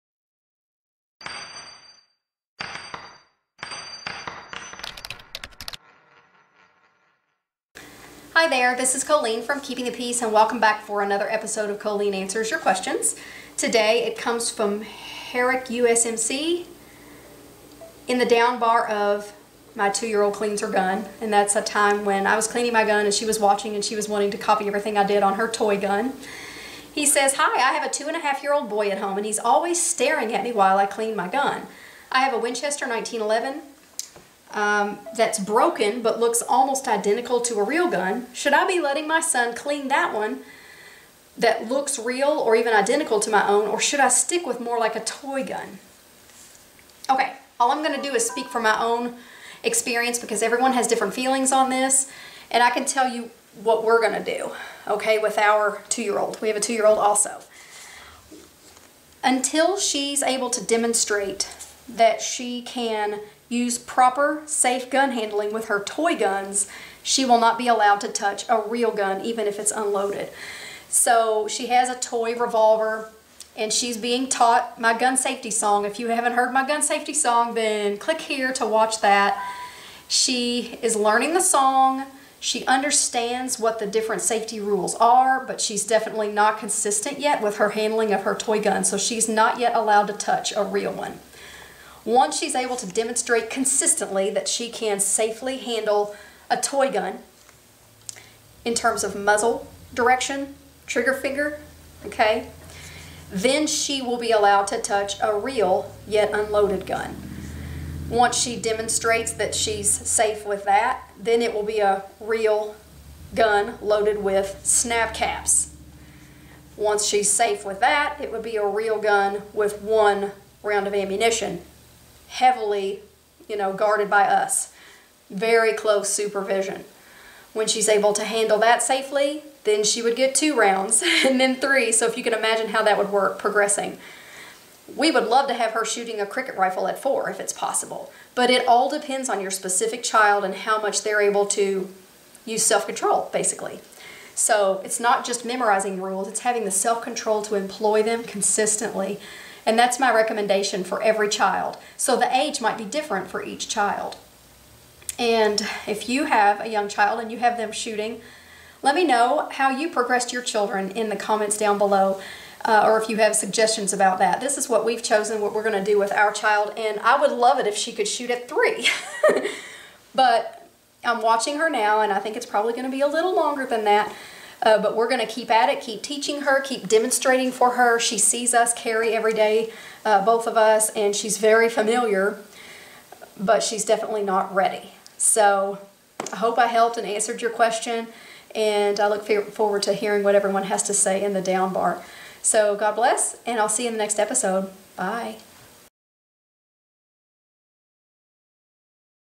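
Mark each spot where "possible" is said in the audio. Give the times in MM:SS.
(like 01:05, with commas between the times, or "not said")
02:17.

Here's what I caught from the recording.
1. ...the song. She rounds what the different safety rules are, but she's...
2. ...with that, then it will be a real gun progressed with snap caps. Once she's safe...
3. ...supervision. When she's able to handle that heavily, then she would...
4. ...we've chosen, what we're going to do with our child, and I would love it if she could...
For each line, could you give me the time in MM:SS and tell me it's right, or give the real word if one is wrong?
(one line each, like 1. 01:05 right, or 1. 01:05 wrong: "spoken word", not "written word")
1. 01:21 wrong: "understands", not "rounds"
2. 01:50 wrong: "loaded", not "progressed"
3. 02:06 wrong: "safely", not "heavily"
4. 02:44 right.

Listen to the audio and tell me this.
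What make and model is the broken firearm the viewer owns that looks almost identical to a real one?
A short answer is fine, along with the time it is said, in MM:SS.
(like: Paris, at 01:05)
Winchester 1911, at 00:32.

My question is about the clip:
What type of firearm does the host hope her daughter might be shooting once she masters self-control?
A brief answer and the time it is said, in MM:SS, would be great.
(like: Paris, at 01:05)
Cricket rifle, at 02:16.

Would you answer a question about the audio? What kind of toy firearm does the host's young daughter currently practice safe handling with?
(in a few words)
Toy revolver.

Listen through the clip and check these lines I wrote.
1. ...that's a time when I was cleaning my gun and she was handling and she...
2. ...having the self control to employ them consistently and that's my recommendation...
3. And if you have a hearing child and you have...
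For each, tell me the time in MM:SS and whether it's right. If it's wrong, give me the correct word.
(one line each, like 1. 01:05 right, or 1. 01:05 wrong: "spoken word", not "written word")
1. 00:21 wrong: "watching", not "handling"
2. 02:26 right
3. 02:35 wrong: "young", not "hearing".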